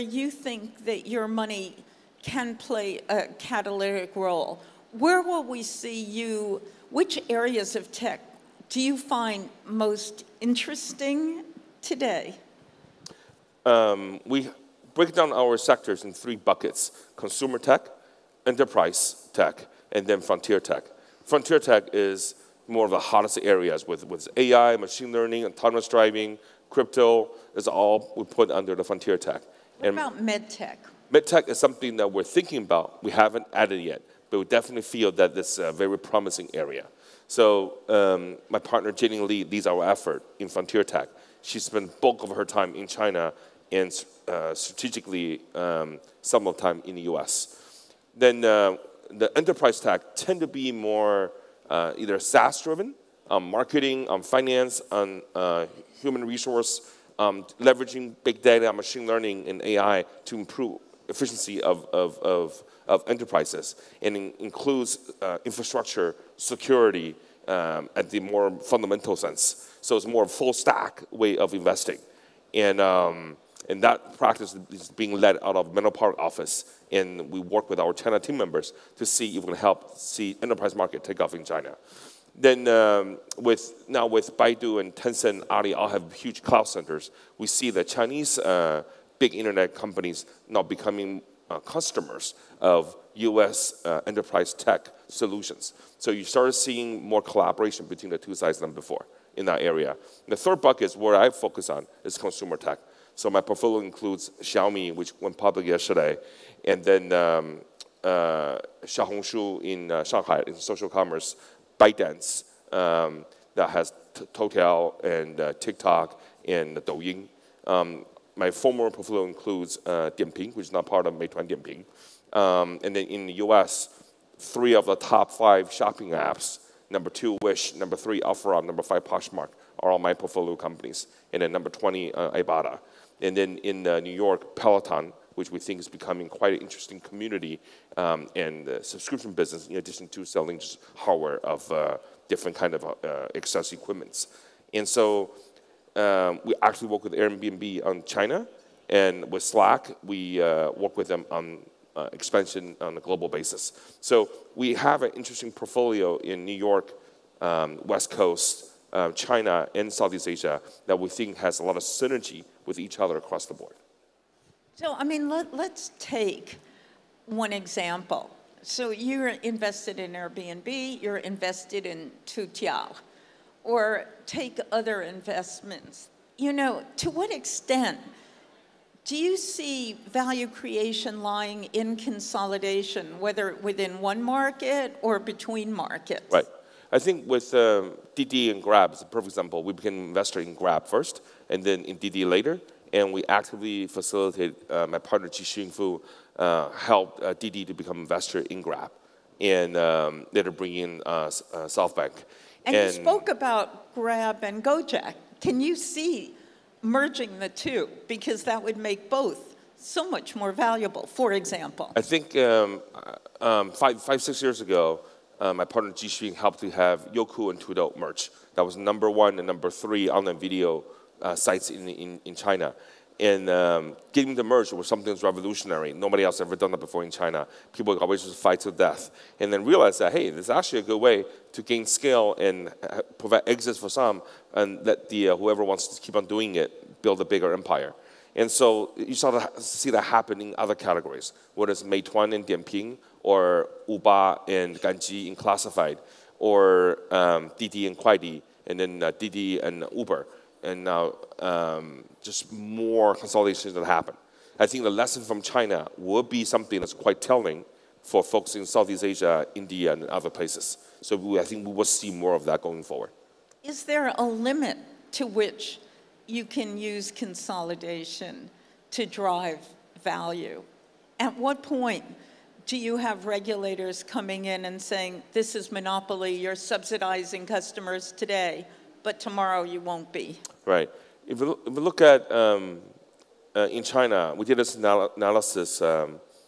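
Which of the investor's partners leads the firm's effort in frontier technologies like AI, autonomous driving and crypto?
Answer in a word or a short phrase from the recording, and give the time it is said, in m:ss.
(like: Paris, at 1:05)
Jenny Lee, at 0:38.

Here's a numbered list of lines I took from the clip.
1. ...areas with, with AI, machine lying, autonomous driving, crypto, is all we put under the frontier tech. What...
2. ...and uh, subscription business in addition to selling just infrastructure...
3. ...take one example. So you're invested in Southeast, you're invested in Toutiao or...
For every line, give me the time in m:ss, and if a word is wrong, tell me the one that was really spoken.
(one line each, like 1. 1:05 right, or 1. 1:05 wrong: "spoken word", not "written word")
1. 0:23 wrong: "learning", not "lying"
2. 2:18 wrong: "hardware", not "infrastructure"
3. 2:45 wrong: "Airbnb", not "Southeast".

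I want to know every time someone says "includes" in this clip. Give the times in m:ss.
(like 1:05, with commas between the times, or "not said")
1:04, 1:43, 1:59.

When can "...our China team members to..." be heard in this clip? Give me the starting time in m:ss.
1:17.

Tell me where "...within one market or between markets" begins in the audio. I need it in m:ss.
3:03.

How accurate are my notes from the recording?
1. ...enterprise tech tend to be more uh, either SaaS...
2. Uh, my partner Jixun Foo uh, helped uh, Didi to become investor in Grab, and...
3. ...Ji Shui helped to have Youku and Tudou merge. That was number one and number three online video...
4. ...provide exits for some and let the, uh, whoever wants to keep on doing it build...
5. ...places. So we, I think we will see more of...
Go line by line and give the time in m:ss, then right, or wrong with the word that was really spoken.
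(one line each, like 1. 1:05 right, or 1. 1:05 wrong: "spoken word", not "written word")
1. 0:49 right
2. 3:14 right
3. 3:35 right
4. 3:53 right
5. 4:20 right.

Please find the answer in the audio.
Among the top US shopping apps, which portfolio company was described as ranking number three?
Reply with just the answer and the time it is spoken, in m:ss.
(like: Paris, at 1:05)
OfferUp, at 2:08.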